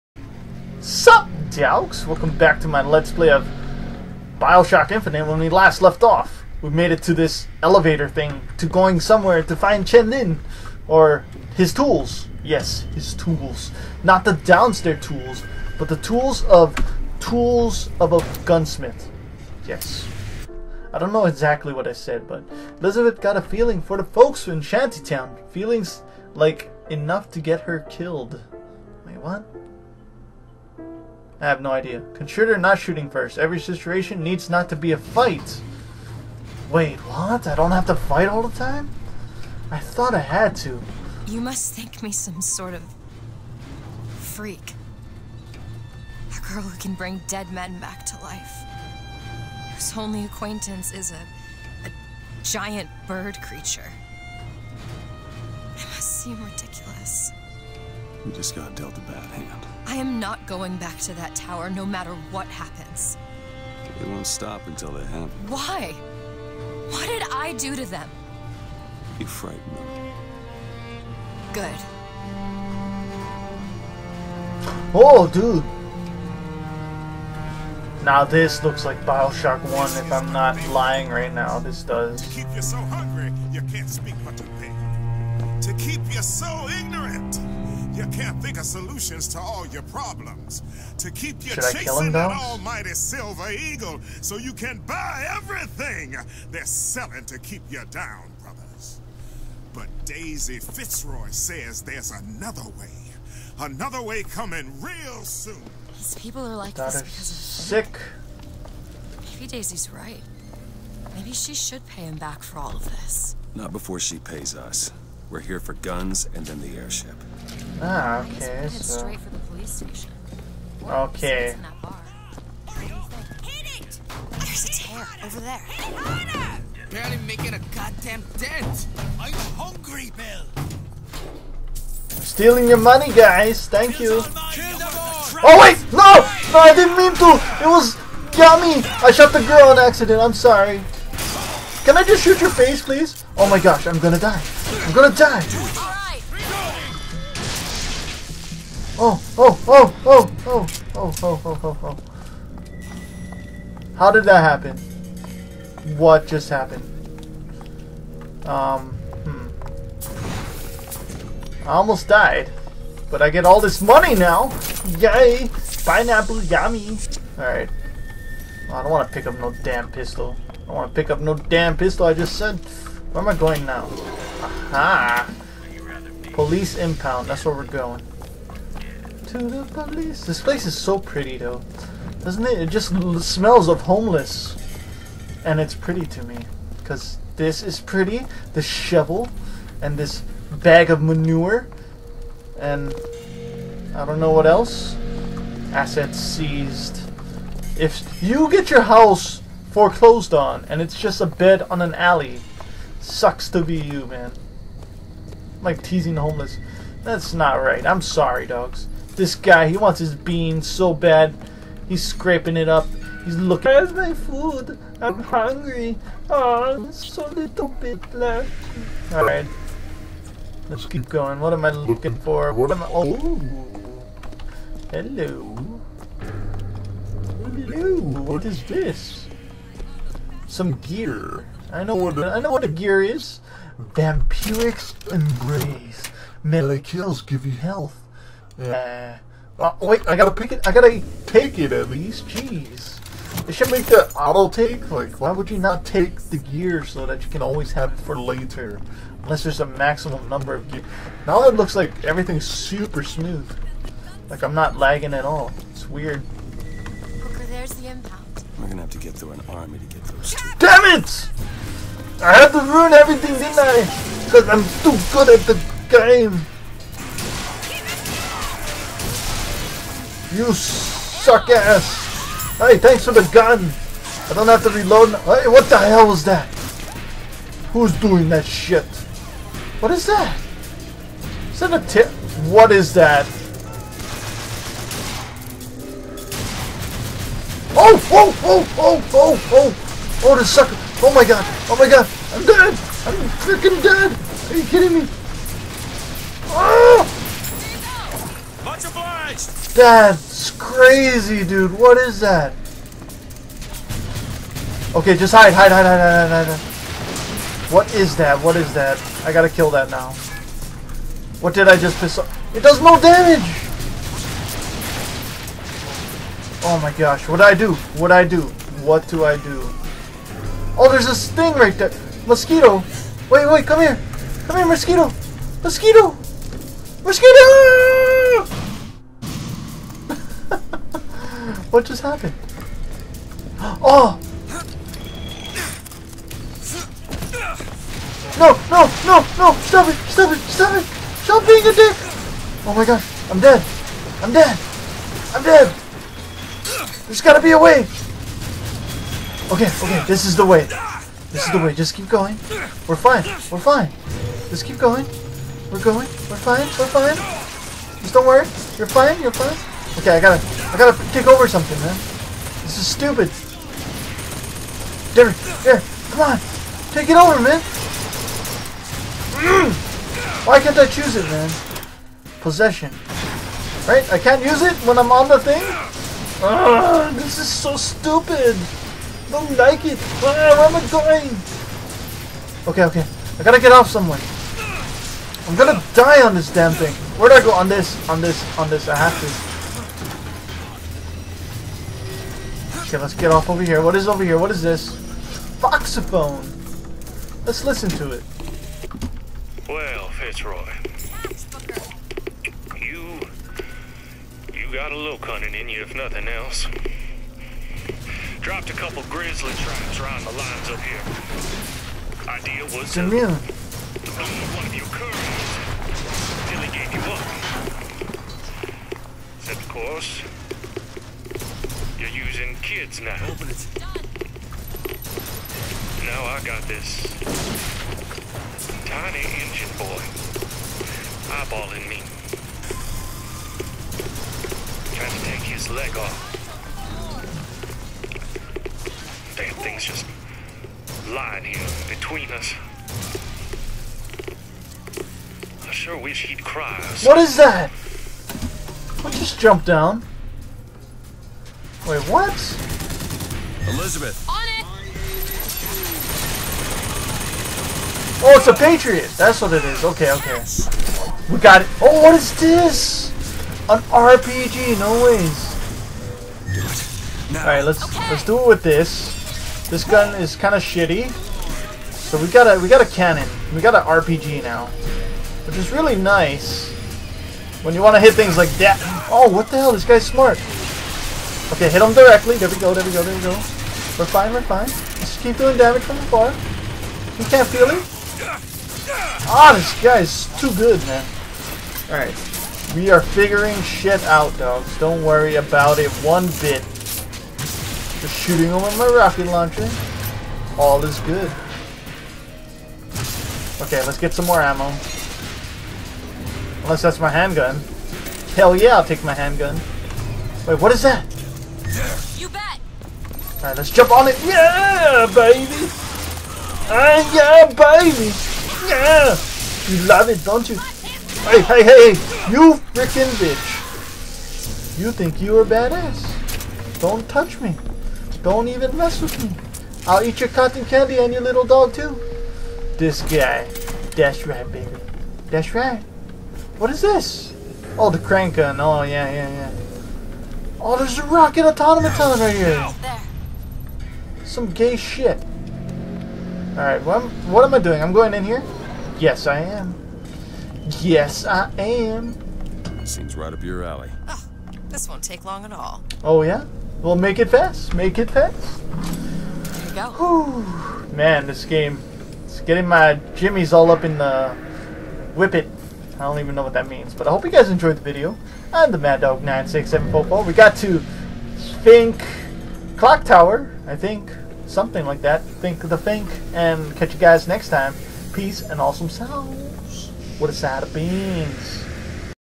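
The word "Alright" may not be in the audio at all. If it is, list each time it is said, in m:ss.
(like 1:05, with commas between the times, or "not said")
2:47, 8:11, 8:33, 9:06.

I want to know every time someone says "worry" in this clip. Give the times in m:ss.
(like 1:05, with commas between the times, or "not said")
5:58, 8:15.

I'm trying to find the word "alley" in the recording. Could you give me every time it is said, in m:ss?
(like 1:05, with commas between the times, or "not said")
3:21, 9:13.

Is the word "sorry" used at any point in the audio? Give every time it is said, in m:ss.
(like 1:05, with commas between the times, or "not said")
2:20, 3:28.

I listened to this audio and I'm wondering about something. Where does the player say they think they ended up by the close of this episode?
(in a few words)
Fink Clock Tower.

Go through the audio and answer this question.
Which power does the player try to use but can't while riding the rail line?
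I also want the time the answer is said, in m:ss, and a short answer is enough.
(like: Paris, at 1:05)
Possession, at 6:12.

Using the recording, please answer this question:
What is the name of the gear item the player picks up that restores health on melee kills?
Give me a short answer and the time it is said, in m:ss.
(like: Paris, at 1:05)
Vampiric embrace, at 3:53.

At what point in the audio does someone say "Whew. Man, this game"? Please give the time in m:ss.
9:20.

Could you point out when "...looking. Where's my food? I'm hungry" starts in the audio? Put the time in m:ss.
3:33.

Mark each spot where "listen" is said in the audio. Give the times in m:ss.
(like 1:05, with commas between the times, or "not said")
6:37.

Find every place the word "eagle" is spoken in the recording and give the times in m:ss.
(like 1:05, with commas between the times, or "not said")
1:33.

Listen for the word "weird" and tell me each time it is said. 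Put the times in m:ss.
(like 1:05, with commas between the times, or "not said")
4:15.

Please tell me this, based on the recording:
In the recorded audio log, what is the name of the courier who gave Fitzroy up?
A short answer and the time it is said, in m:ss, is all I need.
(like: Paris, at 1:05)
Jamil, at 6:52.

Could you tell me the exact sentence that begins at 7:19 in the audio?
Damn thing's just lying here between us.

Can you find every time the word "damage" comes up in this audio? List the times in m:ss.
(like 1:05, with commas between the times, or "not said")
5:13, 8:05.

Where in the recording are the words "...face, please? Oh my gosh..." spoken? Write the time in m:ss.
2:22.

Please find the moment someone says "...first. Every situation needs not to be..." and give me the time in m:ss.
0:33.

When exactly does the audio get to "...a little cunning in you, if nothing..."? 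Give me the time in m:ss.
6:44.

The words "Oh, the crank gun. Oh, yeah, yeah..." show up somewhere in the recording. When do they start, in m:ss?
8:57.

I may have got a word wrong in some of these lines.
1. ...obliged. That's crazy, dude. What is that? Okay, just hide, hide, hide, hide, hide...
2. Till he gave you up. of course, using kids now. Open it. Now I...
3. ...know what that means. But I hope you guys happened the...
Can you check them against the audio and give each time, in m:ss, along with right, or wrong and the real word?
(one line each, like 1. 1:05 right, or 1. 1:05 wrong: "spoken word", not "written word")
1. 4:58 right
2. 6:56 right
3. 9:26 wrong: "enjoyed", not "happened".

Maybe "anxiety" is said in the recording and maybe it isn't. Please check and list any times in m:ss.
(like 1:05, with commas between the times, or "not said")
not said.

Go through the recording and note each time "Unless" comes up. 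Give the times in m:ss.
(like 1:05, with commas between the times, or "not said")
4:09, 8:26.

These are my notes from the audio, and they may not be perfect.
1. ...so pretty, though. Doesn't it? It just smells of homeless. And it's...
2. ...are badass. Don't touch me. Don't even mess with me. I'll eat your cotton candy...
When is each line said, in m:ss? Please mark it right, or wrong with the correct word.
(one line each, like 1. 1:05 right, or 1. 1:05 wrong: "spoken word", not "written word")
1. 3:00 right
2. 8:45 right.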